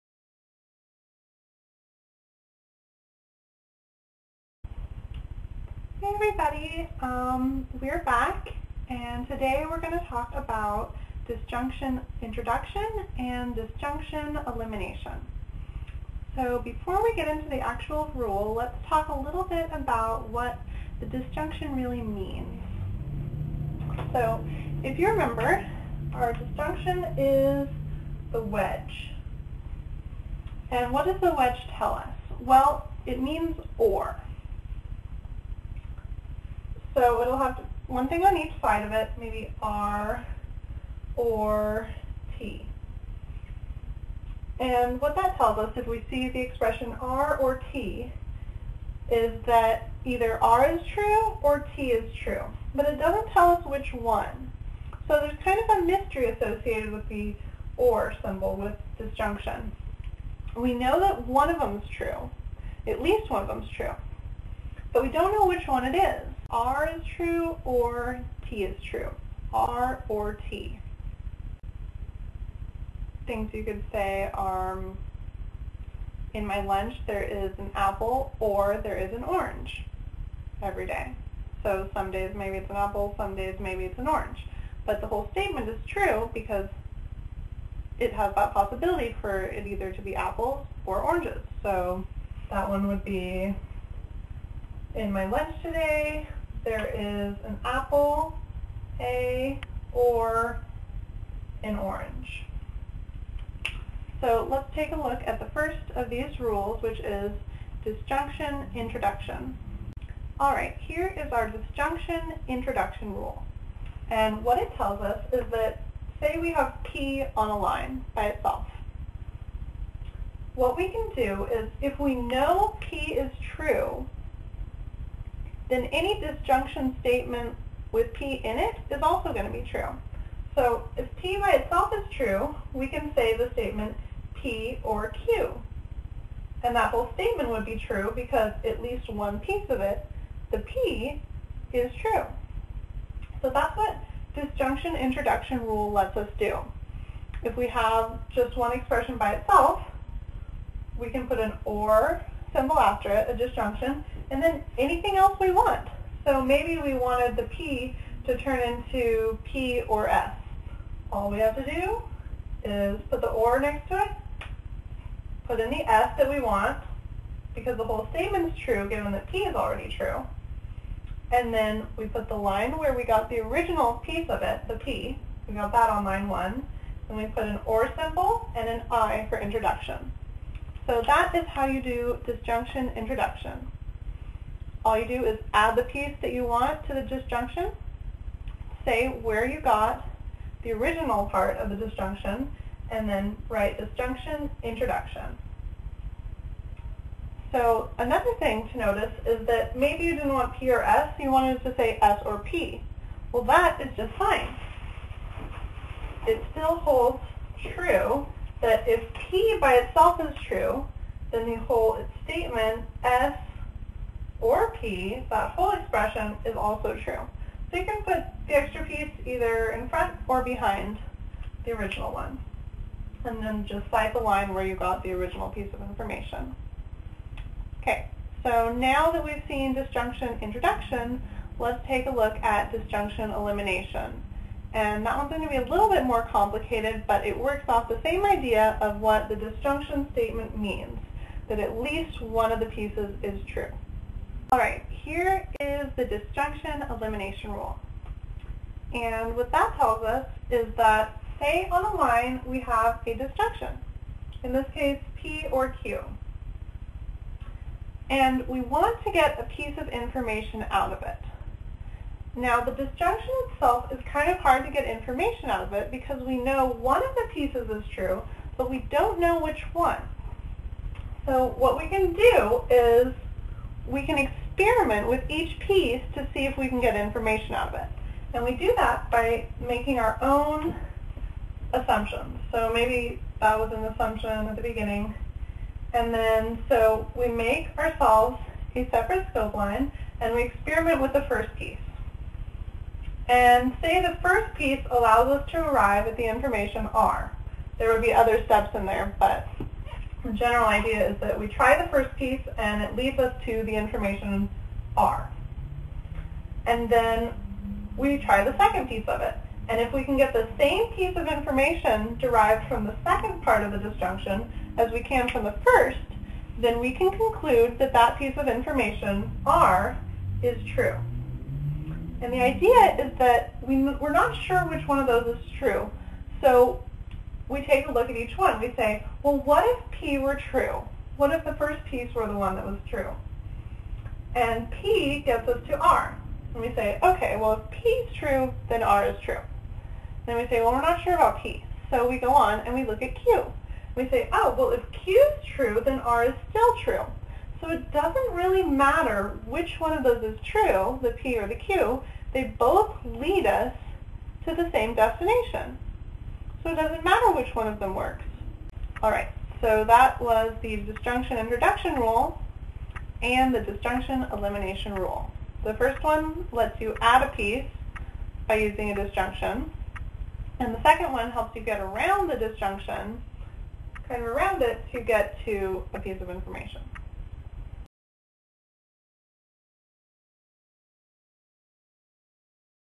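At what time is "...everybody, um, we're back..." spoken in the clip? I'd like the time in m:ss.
0:06.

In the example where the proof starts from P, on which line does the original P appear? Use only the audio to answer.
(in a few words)
Line one.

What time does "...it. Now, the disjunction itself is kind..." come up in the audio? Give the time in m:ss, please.
4:21.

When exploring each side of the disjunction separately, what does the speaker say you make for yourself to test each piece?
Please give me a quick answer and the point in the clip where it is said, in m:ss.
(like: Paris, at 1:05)
A separate scope line, at 4:48.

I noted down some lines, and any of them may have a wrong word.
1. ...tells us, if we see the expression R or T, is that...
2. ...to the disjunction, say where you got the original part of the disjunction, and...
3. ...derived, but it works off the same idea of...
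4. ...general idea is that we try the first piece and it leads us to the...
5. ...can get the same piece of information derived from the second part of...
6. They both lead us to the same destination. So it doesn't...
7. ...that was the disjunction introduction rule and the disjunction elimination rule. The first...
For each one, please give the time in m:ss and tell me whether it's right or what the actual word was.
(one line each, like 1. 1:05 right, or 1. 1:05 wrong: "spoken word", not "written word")
1. 0:45 right
2. 3:06 right
3. 3:56 wrong: "complicated", not "derived"
4. 5:00 right
5. 5:10 right
6. 5:52 right
7. 5:59 right.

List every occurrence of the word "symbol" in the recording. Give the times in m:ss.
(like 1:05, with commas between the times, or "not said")
0:58, 2:32, 2:58.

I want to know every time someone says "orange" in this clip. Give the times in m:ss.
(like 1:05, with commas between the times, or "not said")
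1:19, 1:24, 1:31, 1:41.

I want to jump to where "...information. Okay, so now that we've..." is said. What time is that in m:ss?
3:45.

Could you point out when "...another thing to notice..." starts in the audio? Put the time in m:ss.
3:17.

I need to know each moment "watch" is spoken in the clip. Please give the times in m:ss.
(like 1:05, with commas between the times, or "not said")
not said.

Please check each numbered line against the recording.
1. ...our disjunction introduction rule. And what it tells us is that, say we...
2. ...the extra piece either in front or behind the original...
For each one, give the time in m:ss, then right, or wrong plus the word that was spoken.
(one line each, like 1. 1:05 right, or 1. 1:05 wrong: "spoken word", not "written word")
1. 1:51 right
2. 3:38 right.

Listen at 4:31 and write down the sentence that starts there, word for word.
So what we can do is we can experiment with each piece to see if we can get information out of it.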